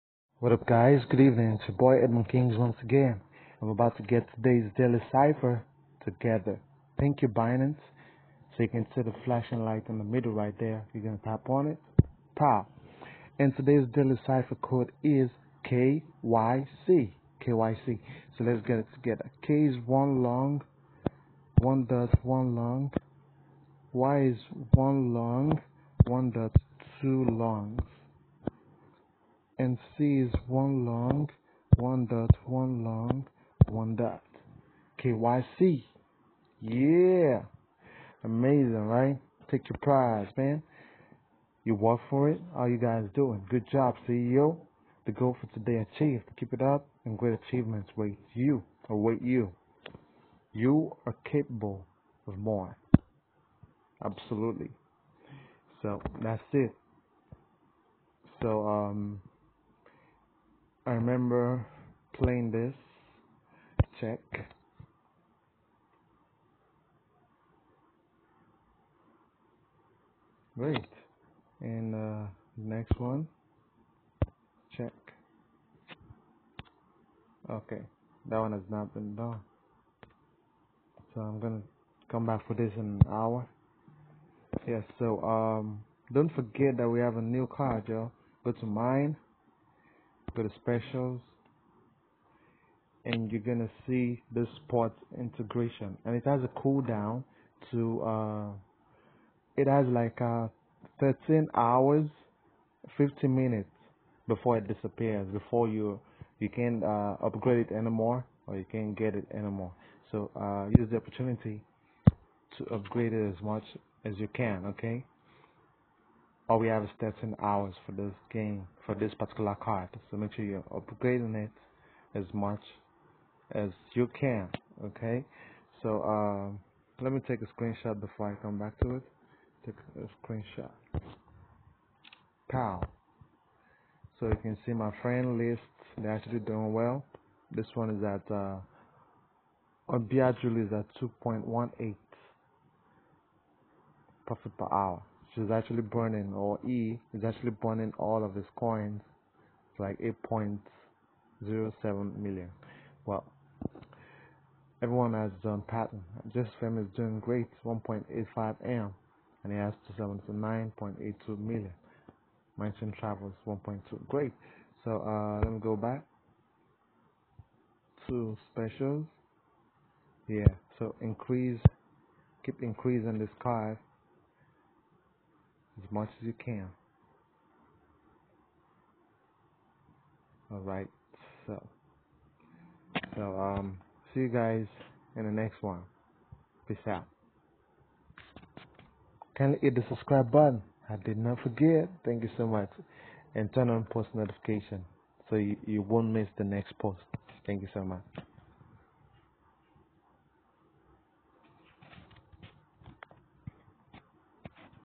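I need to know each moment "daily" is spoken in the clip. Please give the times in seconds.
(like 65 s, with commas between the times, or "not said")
4 s, 13 s.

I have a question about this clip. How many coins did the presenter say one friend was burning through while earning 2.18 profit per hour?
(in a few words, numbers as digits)
8.07 million.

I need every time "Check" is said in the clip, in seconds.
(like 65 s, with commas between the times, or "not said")
63 s, 74 s.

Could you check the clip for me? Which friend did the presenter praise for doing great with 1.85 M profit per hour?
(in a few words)
JustFam.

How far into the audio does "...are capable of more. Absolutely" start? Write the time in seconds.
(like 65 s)
51 s.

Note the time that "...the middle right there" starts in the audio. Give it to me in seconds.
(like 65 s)
9 s.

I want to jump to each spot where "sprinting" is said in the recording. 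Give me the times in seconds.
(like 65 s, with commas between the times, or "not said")
not said.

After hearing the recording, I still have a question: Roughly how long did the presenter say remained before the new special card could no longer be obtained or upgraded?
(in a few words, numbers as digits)
13 hours 50 minutes.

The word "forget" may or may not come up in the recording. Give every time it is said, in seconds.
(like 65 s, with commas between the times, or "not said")
86 s, 191 s.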